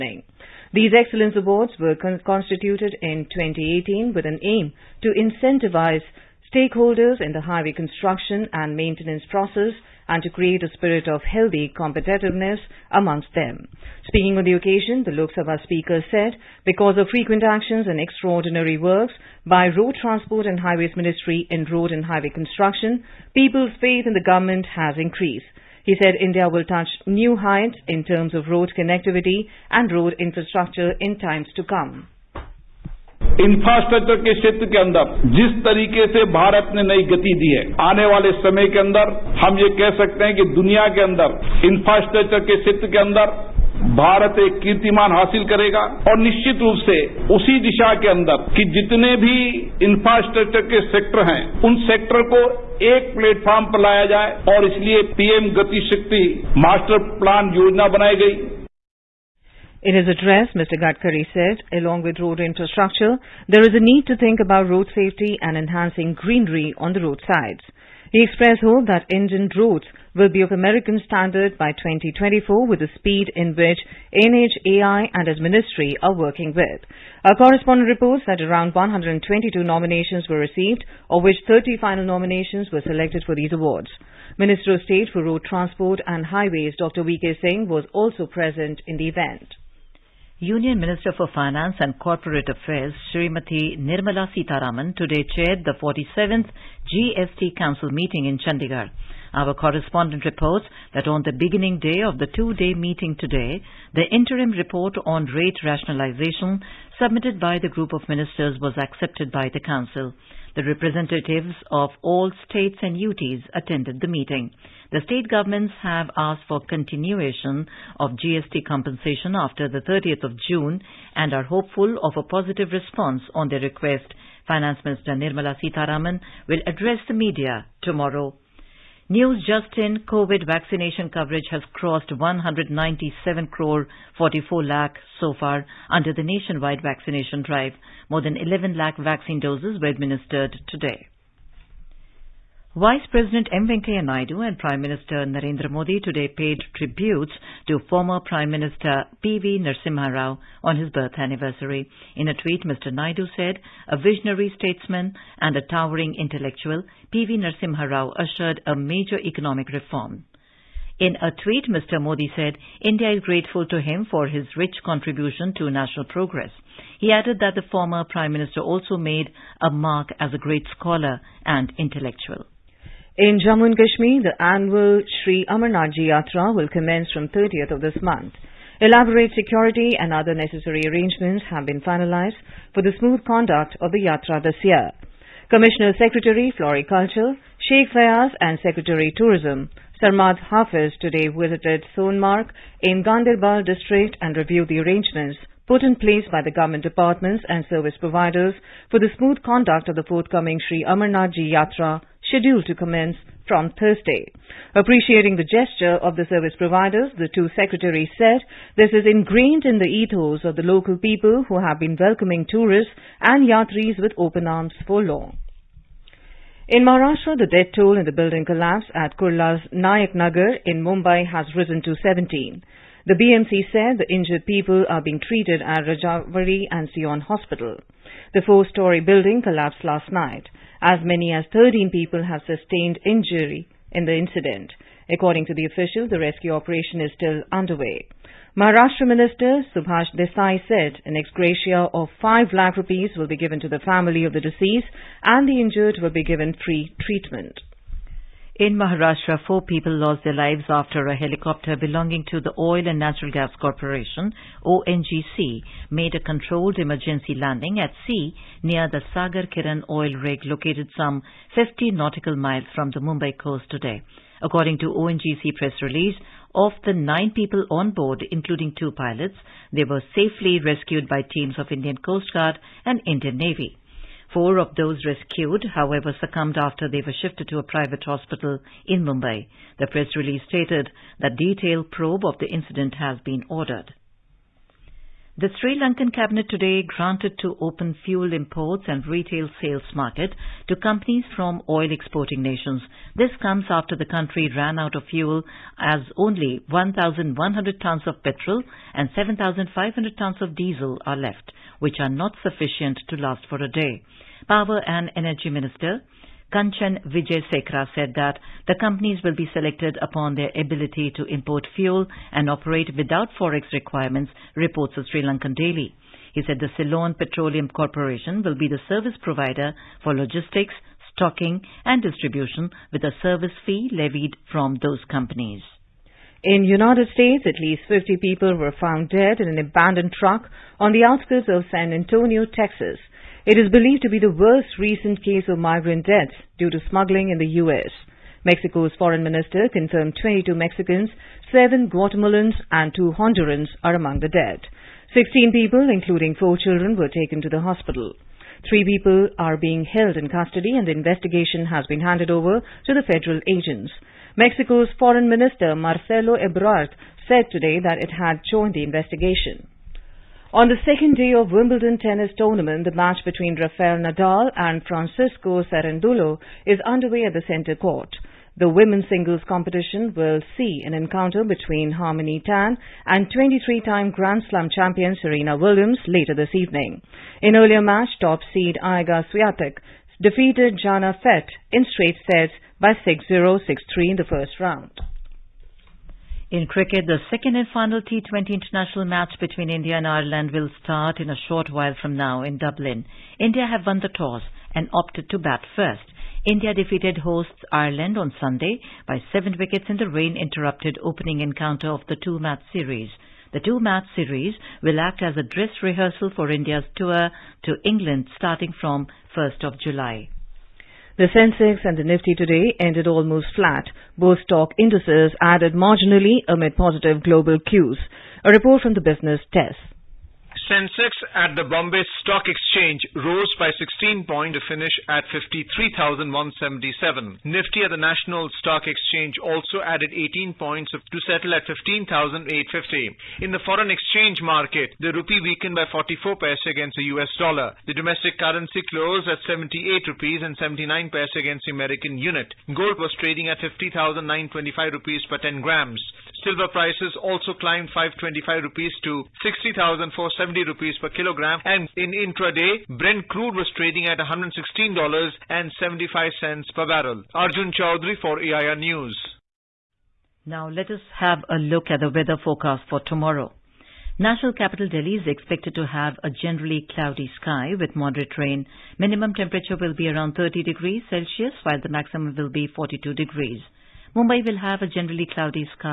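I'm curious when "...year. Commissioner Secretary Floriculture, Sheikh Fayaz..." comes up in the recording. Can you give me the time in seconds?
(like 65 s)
184 s.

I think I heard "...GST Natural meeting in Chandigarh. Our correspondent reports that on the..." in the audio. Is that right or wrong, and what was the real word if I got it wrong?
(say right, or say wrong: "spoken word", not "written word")
wrong: "Council", not "Natural".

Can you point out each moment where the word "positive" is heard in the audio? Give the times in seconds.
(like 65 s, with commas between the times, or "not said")
122 s, 416 s.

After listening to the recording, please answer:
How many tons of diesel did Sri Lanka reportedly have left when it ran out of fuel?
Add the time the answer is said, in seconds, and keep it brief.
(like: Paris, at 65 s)
7,500 tons, at 299 s.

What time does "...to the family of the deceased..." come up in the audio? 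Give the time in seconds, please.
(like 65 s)
243 s.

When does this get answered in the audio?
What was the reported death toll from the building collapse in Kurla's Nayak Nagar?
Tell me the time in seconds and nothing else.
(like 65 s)
222 s.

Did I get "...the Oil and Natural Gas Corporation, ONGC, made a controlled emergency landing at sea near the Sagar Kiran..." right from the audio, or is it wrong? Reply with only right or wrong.
right.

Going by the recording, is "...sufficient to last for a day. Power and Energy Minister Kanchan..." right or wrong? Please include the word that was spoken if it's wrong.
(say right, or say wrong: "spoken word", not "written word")
right.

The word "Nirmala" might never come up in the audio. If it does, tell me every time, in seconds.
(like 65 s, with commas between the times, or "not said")
93 s, 125 s.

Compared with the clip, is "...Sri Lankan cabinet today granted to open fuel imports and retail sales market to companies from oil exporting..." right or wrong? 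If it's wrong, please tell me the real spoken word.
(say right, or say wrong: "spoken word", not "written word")
right.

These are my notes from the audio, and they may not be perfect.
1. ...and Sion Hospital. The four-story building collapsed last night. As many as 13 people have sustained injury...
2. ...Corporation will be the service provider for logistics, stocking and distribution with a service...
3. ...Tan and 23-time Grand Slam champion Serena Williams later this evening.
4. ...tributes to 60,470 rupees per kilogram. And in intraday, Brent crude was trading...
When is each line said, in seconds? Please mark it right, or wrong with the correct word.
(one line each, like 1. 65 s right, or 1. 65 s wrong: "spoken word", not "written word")
1. 226 s right
2. 317 s right
3. 372 s right
4. 448 s wrong: "rupees", not "tributes".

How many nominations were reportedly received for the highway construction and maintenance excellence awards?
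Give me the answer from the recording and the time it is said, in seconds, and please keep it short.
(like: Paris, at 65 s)
122, at 78 s.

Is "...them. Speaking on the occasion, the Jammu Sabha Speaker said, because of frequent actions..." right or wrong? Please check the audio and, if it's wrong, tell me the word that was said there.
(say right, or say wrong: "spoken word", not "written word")
wrong: "Lok", not "Jammu".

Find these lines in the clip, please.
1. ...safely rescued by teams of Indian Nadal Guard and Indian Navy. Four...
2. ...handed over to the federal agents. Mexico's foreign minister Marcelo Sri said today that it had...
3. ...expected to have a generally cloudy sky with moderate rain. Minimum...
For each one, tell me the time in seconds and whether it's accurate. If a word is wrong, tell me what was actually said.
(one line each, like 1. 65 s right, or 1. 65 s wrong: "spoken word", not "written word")
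1. 270 s wrong: "Coast", not "Nadal"
2. 352 s wrong: "Ebrard", not "Sri"
3. 465 s right.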